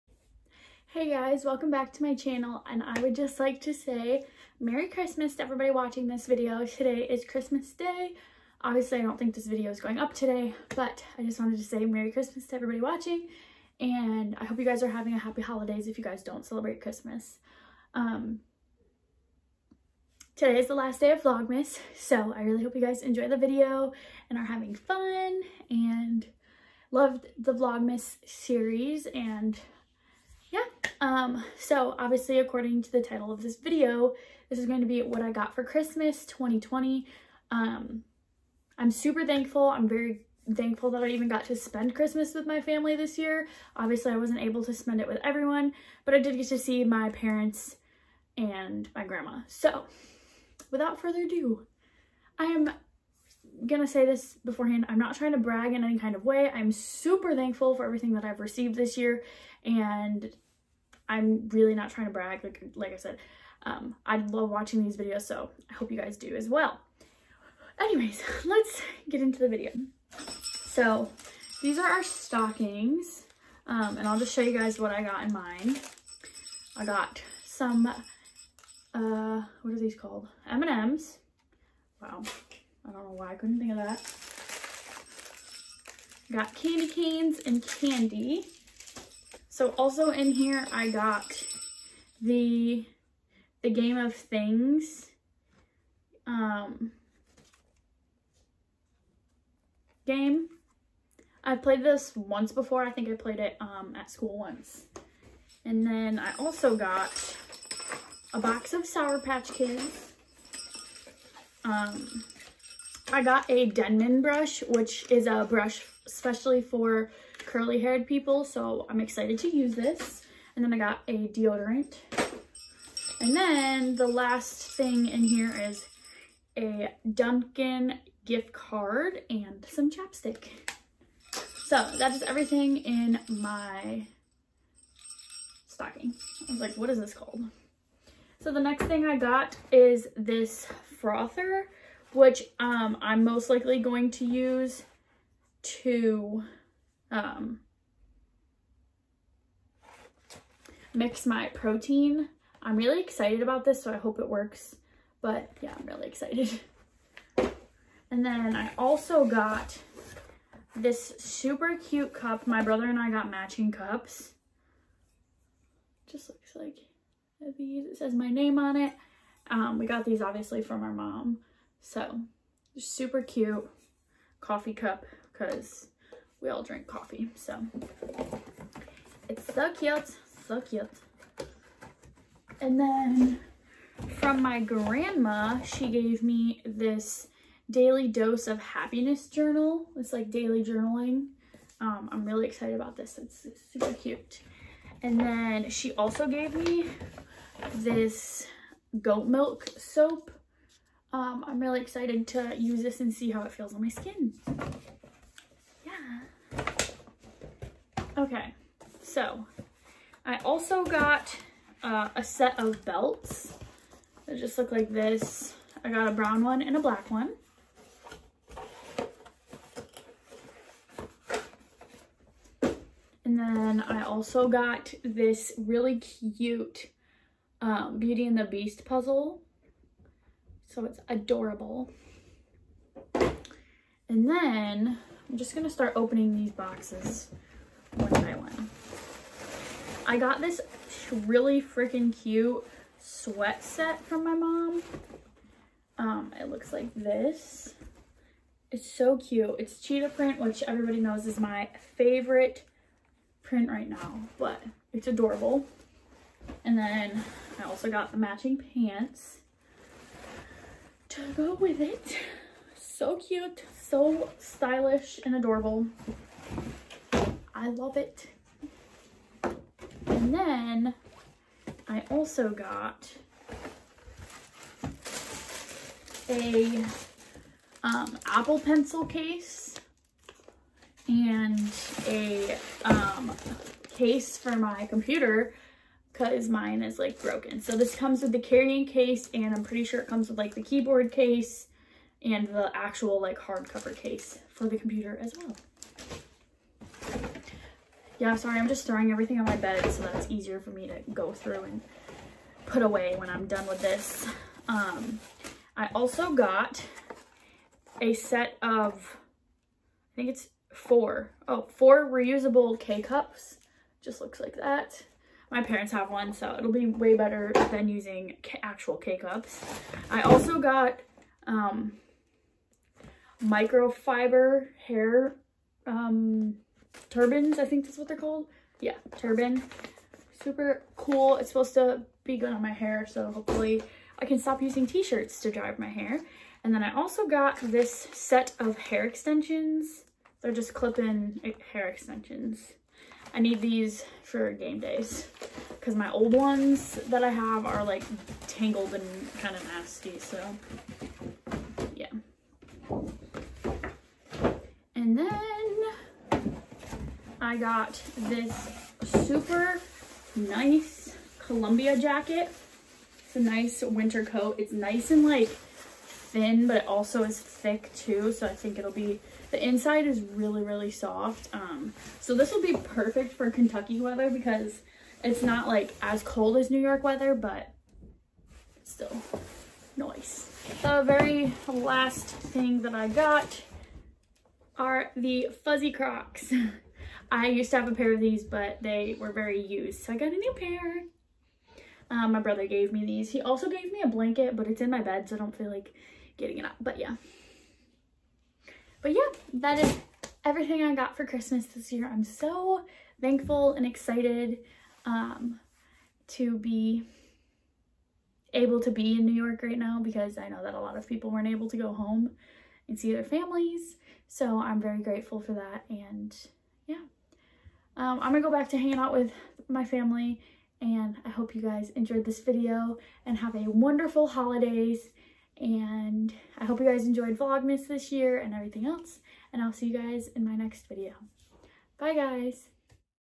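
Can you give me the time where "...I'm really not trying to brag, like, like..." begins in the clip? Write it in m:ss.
1:01.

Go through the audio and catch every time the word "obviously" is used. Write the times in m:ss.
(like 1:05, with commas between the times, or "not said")
0:08, 0:31, 0:43, 2:50.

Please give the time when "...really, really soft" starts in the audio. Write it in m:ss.
6:10.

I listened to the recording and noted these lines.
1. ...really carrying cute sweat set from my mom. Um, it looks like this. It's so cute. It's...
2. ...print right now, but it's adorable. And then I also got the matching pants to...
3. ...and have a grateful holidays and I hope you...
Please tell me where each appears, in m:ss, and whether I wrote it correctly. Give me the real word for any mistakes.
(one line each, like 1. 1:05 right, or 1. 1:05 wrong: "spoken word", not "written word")
1. 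4:01 wrong: "freaking", not "carrying"
2. 4:13 right
3. 7:03 wrong: "wonderful", not "grateful".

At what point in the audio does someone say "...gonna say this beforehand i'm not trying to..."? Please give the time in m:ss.
0:53.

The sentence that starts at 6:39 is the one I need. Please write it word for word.
But yeah, that is everything I got for Christmas this year.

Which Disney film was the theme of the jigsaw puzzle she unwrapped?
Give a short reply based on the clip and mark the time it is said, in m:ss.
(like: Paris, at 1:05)
Beauty and the Beast, at 3:47.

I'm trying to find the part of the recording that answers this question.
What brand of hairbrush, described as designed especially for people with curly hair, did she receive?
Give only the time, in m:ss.
1:53.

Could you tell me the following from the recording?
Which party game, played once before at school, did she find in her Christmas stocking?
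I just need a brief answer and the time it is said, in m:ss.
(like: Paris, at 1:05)
Game of Things, at 1:33.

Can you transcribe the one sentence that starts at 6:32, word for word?
Um, my brother gave me these.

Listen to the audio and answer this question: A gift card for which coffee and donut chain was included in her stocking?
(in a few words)
Dunkin.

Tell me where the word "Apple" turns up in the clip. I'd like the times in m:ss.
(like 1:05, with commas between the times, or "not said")
4:38.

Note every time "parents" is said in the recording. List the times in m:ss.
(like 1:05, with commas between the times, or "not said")
0:47, 5:15.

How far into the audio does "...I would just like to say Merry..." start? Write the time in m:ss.
0:02.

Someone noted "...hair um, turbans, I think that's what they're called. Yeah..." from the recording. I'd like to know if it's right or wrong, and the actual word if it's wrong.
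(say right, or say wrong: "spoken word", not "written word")
right.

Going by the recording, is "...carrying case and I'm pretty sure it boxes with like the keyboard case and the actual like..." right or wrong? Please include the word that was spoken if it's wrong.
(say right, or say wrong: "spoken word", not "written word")
wrong: "comes", not "boxes".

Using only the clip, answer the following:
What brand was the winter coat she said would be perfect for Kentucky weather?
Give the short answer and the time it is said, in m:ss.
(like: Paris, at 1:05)
Columbia, at 6:01.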